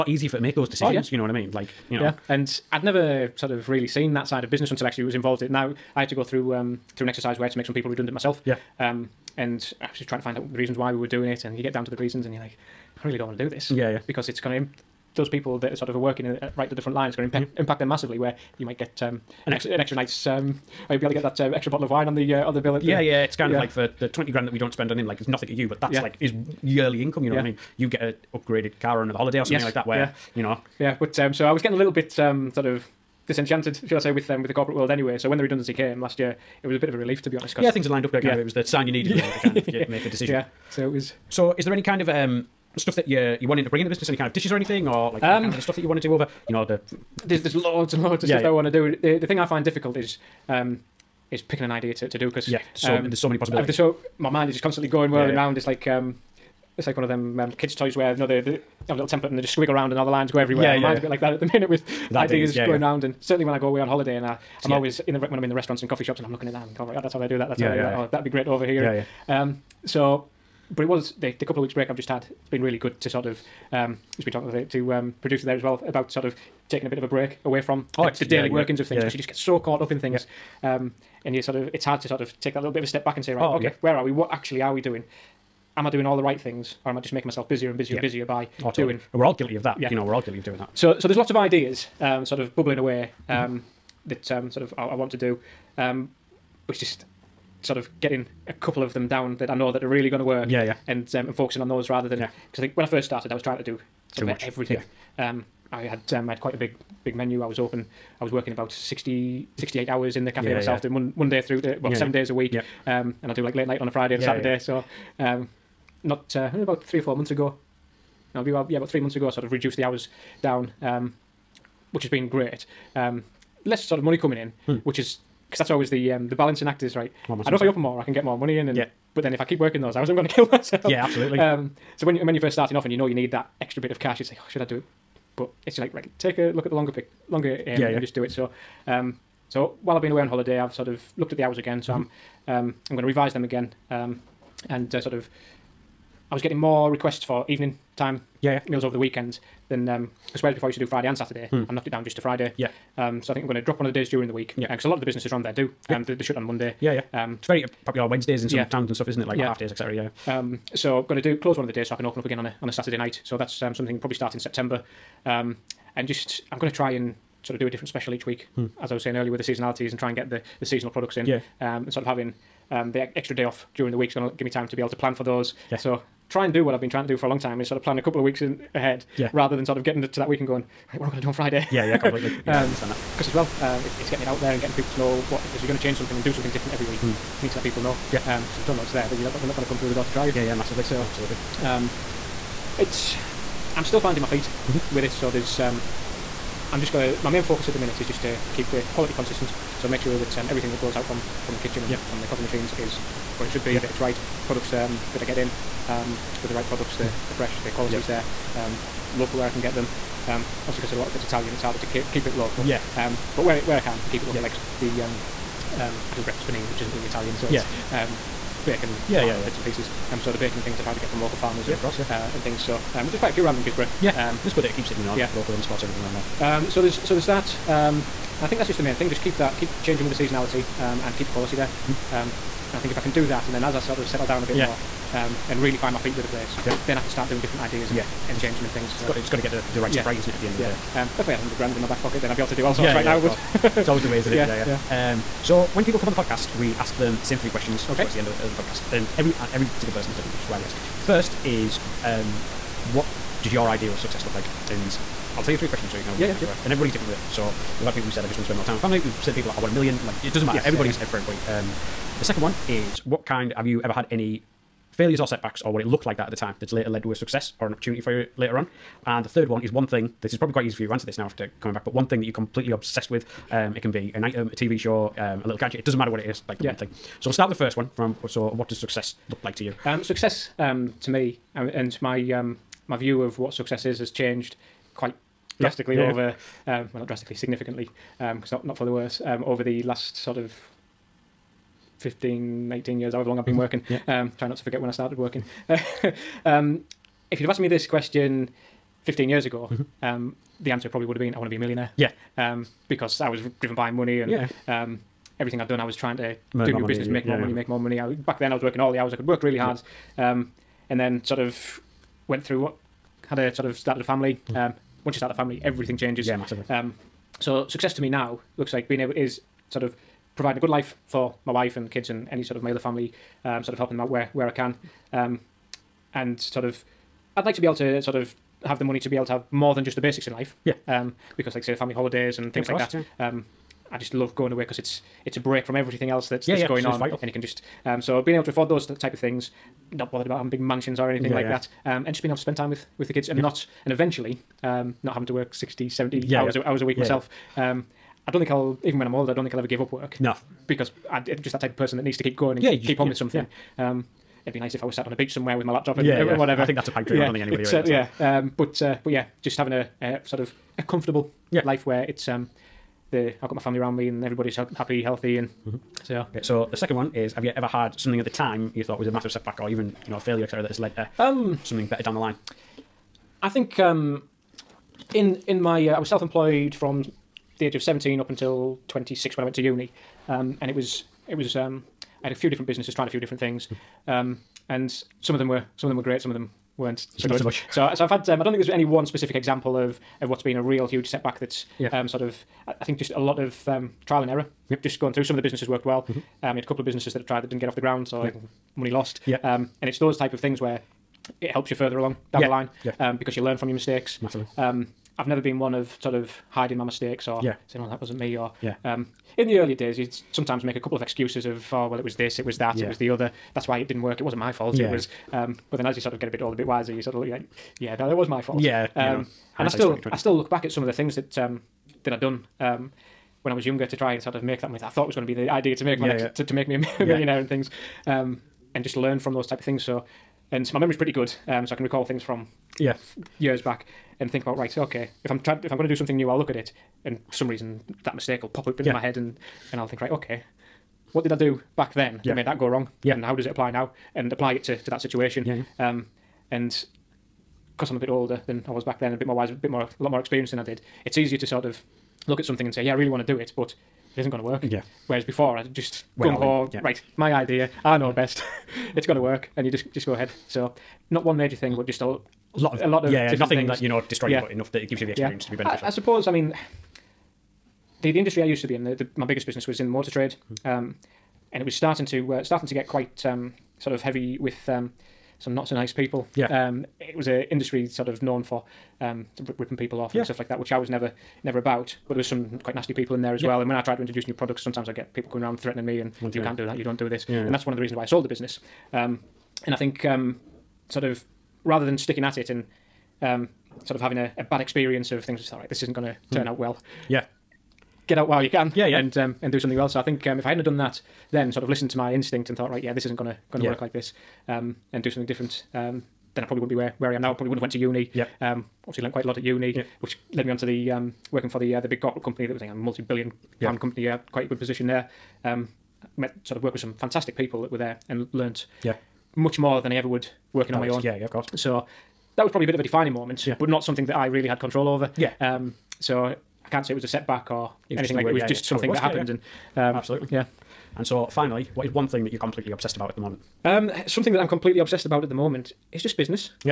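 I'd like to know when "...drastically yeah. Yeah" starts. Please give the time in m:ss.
4:45.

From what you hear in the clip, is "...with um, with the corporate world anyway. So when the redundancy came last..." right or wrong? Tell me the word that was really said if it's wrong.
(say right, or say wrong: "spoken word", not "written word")
right.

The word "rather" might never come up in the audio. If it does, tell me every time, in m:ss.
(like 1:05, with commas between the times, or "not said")
1:41, 2:59, 8:11.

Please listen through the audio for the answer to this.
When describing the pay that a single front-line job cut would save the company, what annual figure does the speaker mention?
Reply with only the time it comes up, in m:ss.
0:24.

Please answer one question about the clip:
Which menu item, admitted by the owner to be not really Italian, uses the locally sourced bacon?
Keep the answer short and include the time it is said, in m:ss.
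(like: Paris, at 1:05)
breakfast panini, at 3:36.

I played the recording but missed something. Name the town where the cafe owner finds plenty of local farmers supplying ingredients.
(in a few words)
Guisborough.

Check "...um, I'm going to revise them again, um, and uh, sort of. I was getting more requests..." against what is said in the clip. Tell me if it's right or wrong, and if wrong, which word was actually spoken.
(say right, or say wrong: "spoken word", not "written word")
right.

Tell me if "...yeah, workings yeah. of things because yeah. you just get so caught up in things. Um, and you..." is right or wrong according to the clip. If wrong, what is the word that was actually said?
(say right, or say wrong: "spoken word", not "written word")
right.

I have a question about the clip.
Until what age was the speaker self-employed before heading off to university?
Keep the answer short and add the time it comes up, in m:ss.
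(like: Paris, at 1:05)
26, at 6:18.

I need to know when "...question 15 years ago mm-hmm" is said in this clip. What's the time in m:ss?
4:57.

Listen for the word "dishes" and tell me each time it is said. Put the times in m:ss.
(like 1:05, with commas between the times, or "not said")
0:44.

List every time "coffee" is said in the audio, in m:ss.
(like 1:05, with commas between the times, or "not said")
1:05, 3:22.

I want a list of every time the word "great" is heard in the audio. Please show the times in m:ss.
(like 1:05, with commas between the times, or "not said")
1:08, 2:02, 6:26.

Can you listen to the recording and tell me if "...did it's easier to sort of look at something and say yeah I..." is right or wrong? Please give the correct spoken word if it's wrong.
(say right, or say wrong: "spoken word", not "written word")
right.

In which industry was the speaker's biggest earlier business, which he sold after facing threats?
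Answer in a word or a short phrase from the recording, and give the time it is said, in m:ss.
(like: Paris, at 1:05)
motor trade, at 7:49.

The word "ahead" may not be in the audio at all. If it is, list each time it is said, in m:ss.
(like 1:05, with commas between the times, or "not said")
2:58, 7:40.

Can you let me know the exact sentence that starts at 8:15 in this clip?
Just thought, right, this isn't going to hmm.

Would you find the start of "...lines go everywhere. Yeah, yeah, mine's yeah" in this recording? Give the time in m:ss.
1:00.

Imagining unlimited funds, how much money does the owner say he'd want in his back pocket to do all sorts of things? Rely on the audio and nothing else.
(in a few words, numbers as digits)
100 grand.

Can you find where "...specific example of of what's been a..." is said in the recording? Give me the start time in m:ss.
6:29.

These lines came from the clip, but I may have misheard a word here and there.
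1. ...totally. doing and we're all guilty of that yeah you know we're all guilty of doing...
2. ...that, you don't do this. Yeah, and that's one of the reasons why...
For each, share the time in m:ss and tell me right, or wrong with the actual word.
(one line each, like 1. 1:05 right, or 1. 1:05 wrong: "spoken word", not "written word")
1. 1:28 right
2. 8:06 right.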